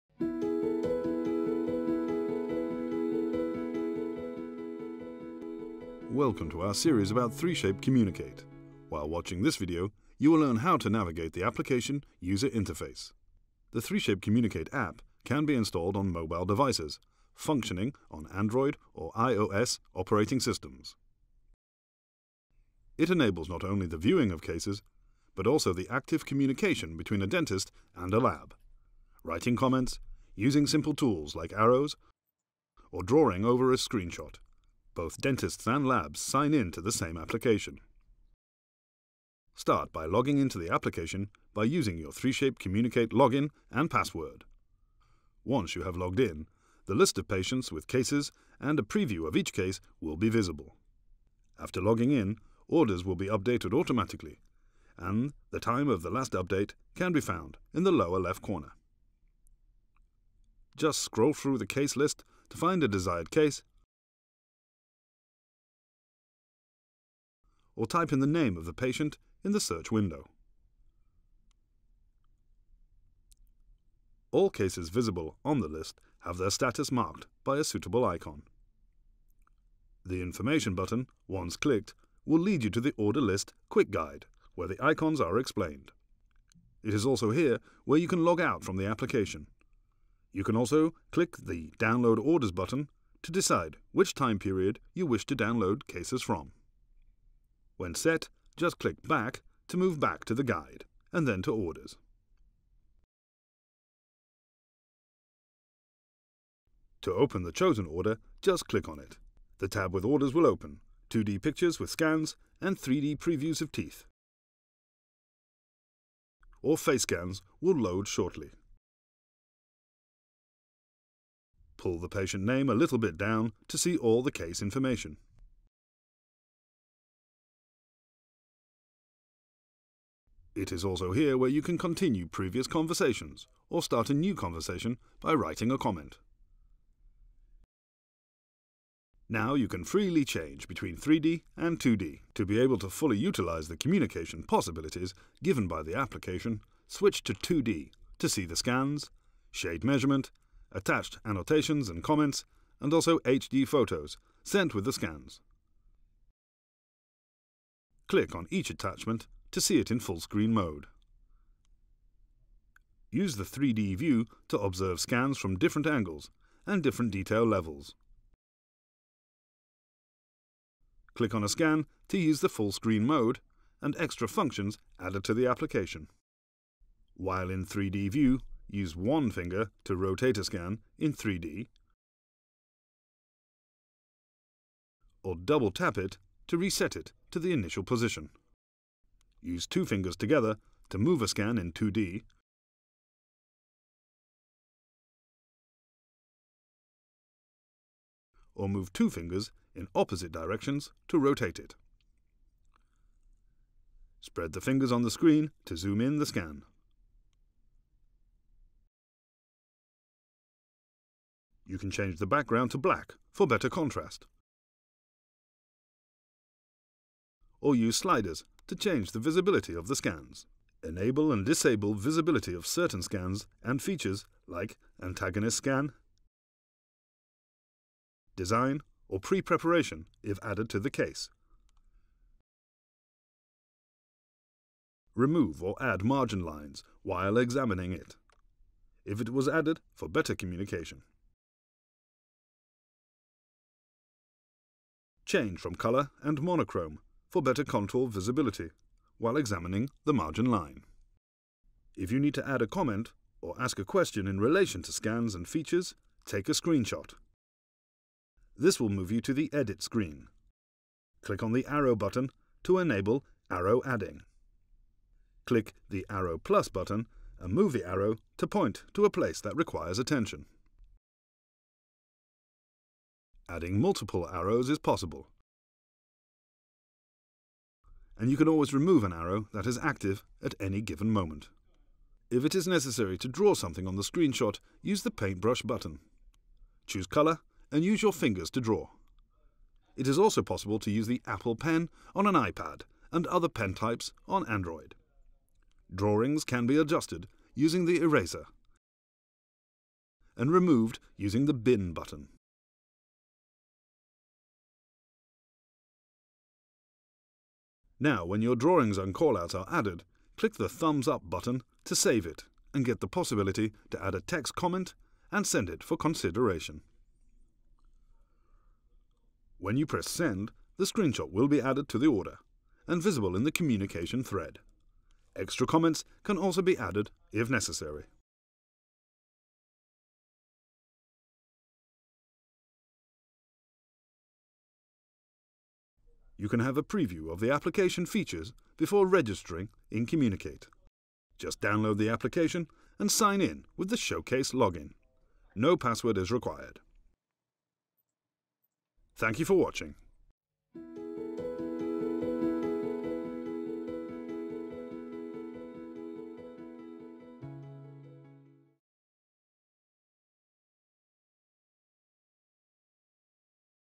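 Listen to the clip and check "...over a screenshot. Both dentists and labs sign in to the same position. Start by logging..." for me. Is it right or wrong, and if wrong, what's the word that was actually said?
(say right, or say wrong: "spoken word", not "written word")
wrong: "application", not "position".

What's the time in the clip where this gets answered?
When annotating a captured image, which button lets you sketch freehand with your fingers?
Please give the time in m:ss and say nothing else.
4:45.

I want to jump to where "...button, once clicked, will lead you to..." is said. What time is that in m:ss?
1:20.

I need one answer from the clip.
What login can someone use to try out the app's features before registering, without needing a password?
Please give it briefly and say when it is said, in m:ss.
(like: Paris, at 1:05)
Showcase, at 5:44.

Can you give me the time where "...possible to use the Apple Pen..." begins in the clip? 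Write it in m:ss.
4:50.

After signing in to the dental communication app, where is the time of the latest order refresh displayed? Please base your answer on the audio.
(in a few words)
lower left corner.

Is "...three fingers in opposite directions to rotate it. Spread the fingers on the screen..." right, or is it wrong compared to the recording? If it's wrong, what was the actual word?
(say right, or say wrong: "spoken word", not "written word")
wrong: "two", not "three".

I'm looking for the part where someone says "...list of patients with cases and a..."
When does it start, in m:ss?
0:46.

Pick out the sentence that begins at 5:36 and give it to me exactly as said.
you can have a preview of the application features before registering in Communicate.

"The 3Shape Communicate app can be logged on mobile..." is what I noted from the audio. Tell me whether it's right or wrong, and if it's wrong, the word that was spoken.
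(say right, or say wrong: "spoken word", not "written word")
wrong: "installed", not "logged".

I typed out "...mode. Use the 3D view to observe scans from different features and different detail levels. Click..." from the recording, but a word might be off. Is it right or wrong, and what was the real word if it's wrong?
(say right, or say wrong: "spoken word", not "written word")
wrong: "angles", not "features".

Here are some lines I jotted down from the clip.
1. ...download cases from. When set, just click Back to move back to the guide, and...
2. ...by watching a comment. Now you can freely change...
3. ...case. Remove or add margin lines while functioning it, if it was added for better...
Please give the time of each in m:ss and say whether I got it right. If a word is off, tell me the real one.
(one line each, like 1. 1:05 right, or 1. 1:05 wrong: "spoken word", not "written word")
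1. 1:35 right
2. 2:15 wrong: "writing", not "watching"
3. 3:50 wrong: "examining", not "functioning".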